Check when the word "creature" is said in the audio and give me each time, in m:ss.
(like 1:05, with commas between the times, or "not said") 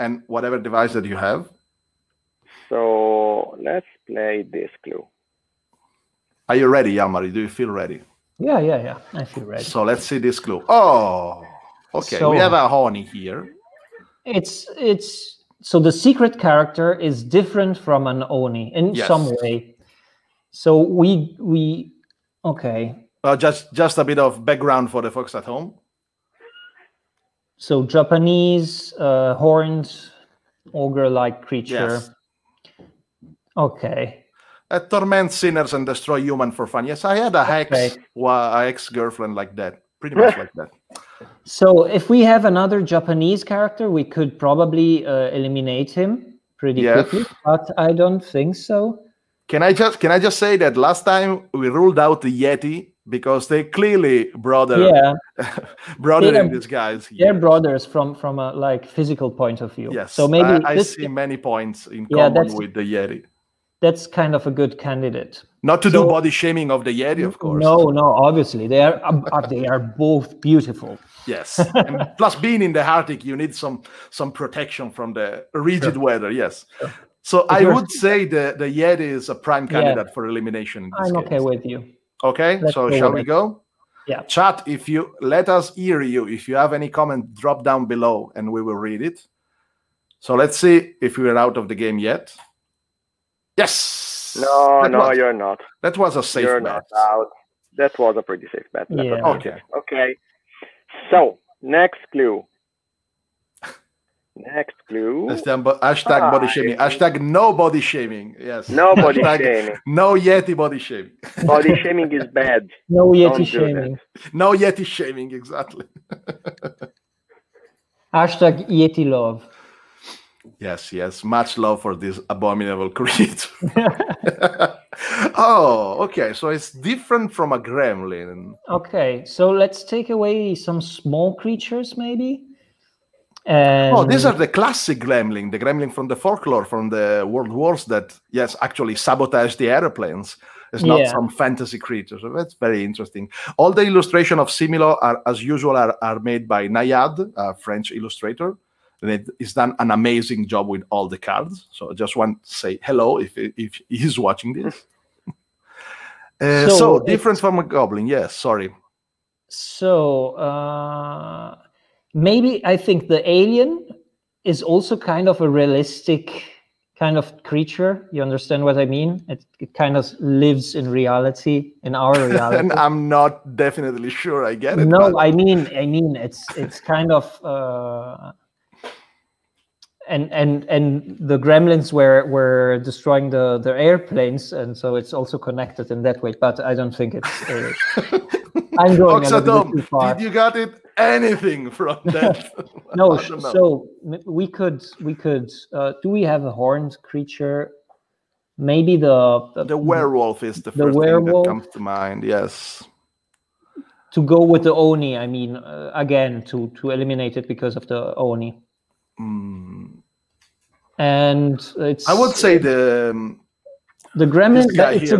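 0:31, 2:02, 2:11, 2:21, 2:47, 3:17.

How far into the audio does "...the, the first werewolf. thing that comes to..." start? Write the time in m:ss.
3:20.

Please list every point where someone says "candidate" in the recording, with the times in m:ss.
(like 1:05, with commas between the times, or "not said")
1:04, 1:19.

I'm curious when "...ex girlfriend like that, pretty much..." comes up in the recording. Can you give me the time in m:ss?
0:38.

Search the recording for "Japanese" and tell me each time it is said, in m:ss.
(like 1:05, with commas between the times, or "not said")
0:27, 0:42.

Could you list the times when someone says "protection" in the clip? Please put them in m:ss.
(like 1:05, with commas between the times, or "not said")
1:14.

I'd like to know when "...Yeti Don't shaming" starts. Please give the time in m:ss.
1:53.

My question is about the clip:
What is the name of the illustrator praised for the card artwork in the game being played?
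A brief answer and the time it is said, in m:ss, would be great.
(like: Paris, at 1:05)
Naïade, at 2:26.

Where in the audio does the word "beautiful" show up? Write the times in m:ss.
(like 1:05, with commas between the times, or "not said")
1:10.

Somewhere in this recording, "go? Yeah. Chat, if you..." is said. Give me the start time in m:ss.
1:23.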